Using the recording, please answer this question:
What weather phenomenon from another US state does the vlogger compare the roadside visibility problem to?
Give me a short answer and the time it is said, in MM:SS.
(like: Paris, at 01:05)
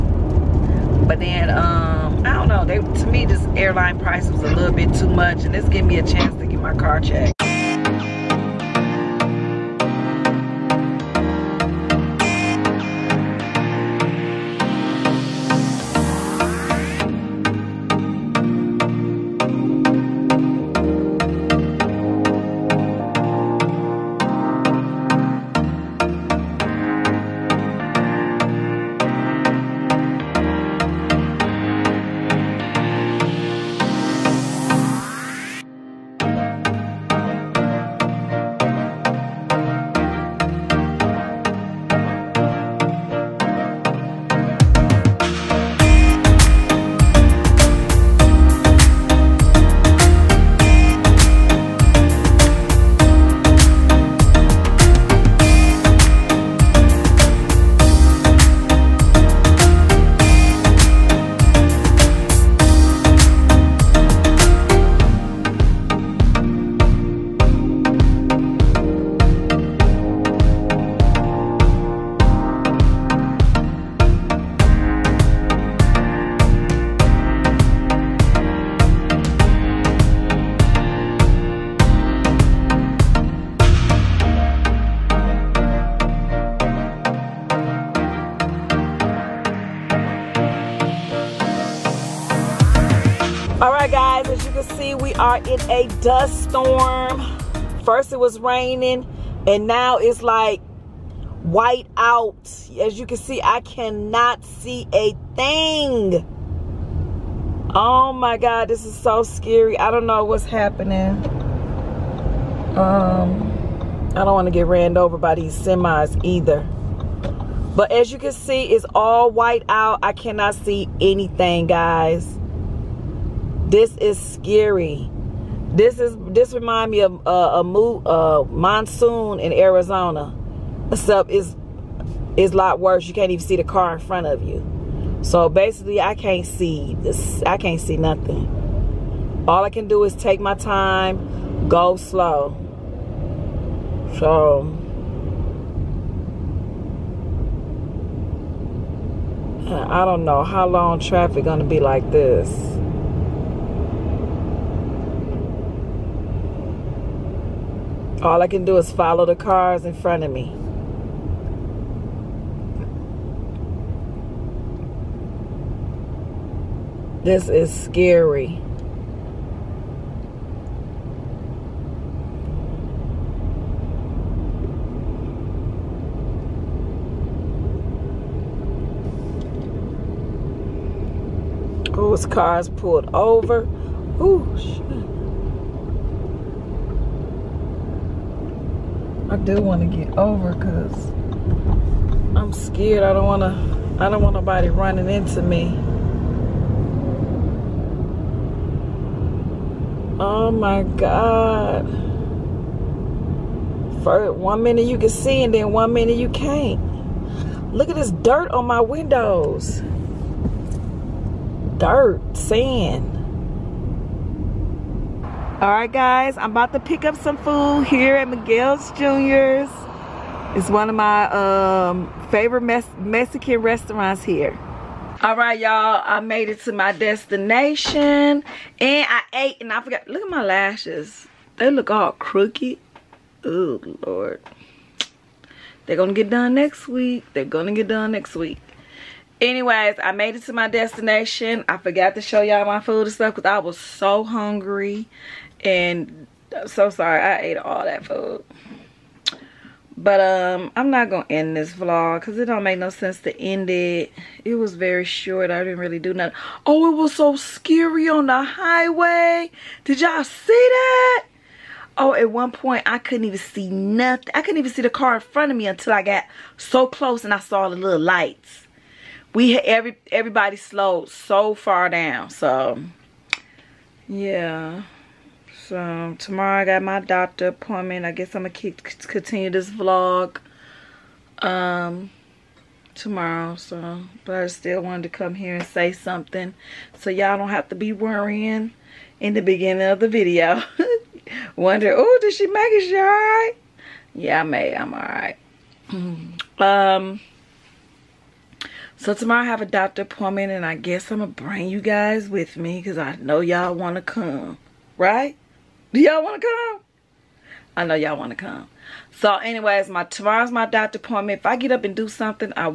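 Monsoon in Arizona, at 02:08.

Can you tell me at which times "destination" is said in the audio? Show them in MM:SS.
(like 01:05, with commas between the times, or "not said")
03:46, 04:00.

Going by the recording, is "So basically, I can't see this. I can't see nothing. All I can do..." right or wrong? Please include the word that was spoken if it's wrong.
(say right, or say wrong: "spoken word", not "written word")
right.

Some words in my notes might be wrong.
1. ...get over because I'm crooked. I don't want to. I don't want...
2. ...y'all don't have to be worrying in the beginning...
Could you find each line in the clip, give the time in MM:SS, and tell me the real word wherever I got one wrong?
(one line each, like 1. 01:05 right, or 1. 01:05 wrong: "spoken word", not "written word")
1. 03:09 wrong: "scared", not "crooked"
2. 04:47 right.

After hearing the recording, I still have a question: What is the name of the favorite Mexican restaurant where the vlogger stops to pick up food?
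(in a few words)
Miguel's Jr.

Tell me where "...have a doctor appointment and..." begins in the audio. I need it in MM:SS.
04:59.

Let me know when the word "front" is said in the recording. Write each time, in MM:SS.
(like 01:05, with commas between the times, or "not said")
02:13, 02:39, 04:25.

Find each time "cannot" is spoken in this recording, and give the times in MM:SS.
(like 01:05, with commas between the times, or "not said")
01:43, 02:00.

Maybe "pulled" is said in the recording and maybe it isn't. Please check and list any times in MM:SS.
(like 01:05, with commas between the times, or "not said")
03:02.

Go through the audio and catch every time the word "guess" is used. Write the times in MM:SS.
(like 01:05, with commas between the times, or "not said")
04:38, 05:00.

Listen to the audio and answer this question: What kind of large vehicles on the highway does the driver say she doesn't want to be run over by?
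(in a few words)
Semis.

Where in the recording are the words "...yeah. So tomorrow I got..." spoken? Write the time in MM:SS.
04:34.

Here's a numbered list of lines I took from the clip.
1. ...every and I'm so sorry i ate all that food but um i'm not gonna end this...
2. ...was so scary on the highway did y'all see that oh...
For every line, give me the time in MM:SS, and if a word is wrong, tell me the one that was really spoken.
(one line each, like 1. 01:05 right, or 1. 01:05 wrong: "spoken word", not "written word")
1. 04:04 wrong: "hungry", not "every"
2. 04:16 right.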